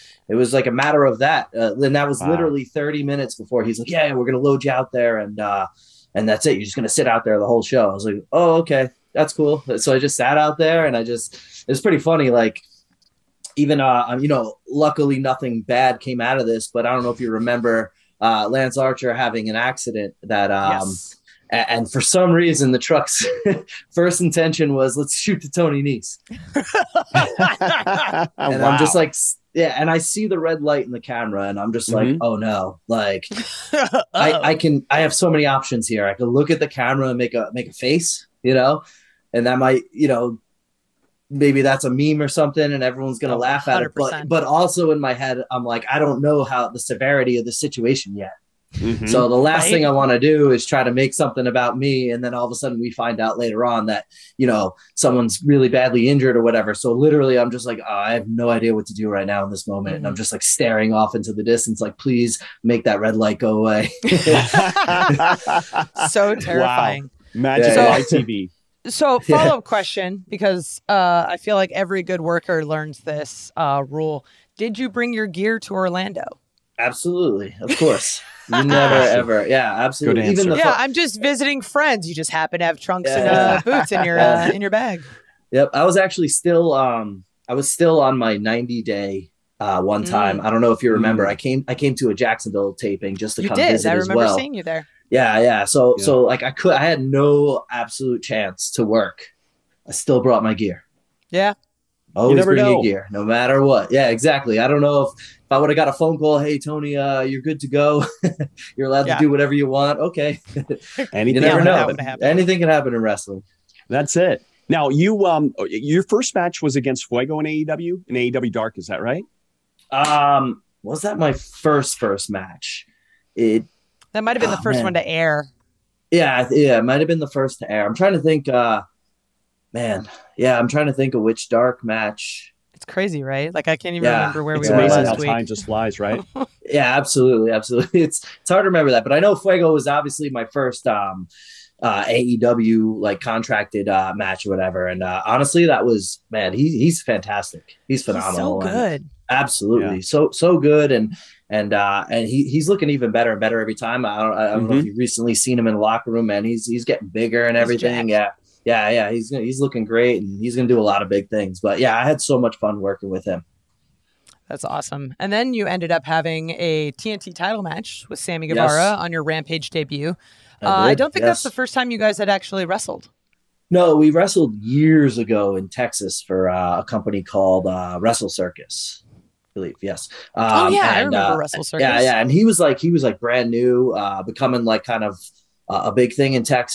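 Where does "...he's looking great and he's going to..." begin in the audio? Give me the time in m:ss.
2:39.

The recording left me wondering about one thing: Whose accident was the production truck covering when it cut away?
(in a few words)
Lance Archer.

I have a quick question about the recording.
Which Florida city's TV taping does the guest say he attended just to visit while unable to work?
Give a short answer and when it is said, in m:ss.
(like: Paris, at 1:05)
Jacksonville, at 1:32.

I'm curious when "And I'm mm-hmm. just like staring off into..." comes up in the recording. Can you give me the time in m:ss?
0:59.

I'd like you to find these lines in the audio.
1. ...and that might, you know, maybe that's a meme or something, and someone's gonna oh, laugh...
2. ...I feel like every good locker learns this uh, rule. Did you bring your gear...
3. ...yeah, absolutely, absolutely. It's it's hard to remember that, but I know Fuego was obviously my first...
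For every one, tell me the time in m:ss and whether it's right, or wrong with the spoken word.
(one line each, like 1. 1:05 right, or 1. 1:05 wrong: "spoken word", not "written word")
1. 0:39 wrong: "everyone", not "someone"
2. 1:11 wrong: "worker", not "locker"
3. 2:16 right.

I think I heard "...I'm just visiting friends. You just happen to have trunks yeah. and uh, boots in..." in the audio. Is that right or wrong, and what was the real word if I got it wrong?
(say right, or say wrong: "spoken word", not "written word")
right.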